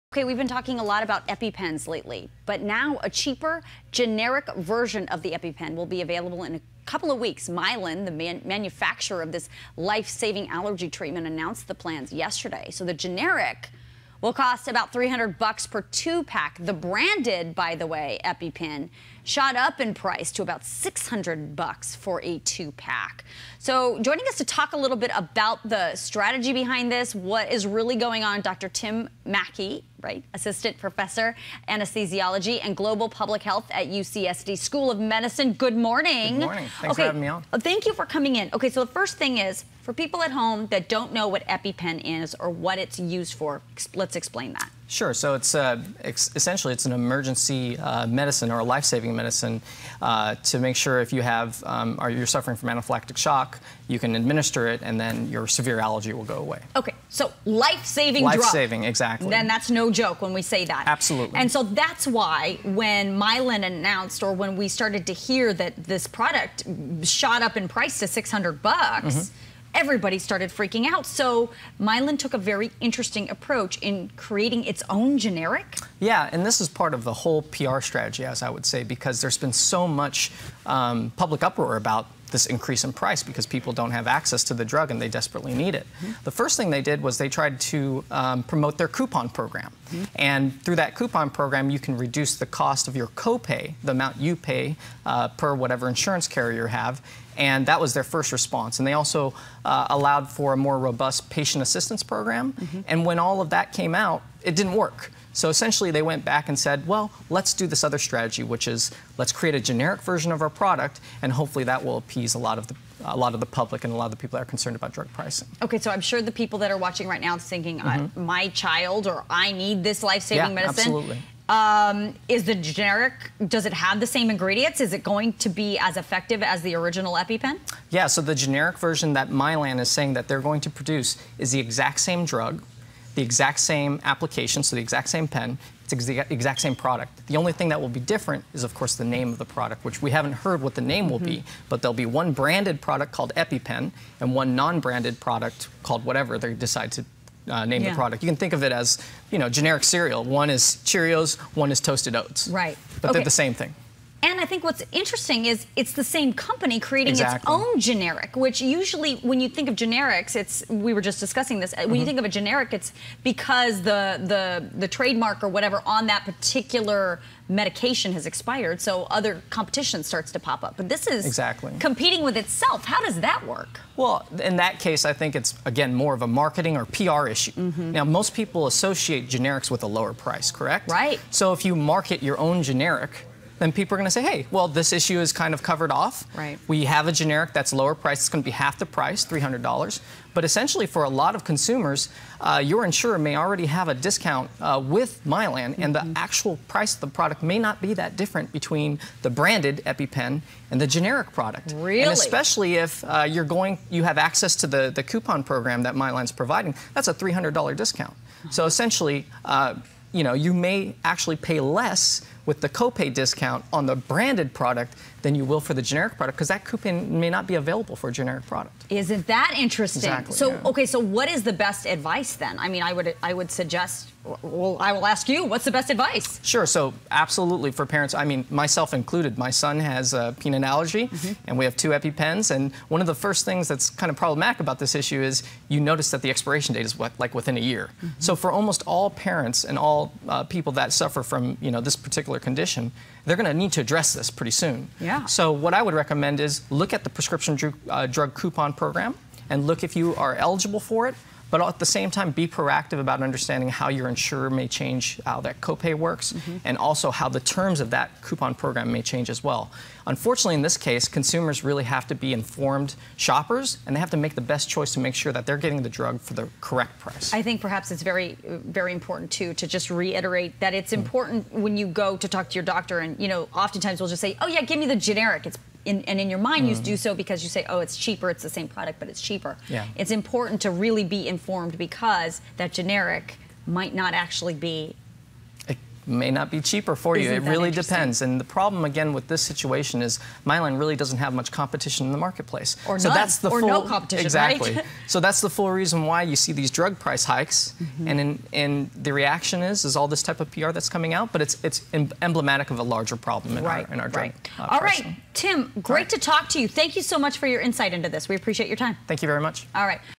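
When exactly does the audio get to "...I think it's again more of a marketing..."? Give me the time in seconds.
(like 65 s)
175 s.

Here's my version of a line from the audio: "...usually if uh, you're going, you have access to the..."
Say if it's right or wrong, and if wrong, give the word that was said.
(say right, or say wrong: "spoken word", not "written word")
wrong: "especially", not "usually".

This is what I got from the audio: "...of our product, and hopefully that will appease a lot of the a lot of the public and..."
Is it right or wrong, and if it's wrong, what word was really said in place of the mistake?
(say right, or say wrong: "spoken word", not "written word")
right.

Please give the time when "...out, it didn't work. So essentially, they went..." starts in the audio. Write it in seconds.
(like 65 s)
104 s.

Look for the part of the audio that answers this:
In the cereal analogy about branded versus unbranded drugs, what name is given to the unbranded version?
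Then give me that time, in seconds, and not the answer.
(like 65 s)
151 s.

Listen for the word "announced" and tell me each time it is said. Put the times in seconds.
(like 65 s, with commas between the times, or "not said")
11 s, 63 s.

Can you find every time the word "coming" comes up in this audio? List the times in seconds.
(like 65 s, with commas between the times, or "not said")
38 s, 300 s.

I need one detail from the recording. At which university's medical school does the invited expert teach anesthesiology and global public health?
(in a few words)
UCSD.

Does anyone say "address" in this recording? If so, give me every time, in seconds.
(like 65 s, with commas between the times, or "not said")
243 s.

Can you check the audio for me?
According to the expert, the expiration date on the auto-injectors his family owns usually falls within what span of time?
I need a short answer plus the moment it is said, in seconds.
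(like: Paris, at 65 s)
within a year, at 237 s.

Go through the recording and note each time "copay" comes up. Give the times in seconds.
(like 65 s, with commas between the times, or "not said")
93 s, 212 s, 255 s.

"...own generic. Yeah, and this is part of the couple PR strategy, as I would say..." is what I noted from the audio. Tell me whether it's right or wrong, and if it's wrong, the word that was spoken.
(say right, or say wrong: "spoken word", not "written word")
wrong: "whole", not "couple".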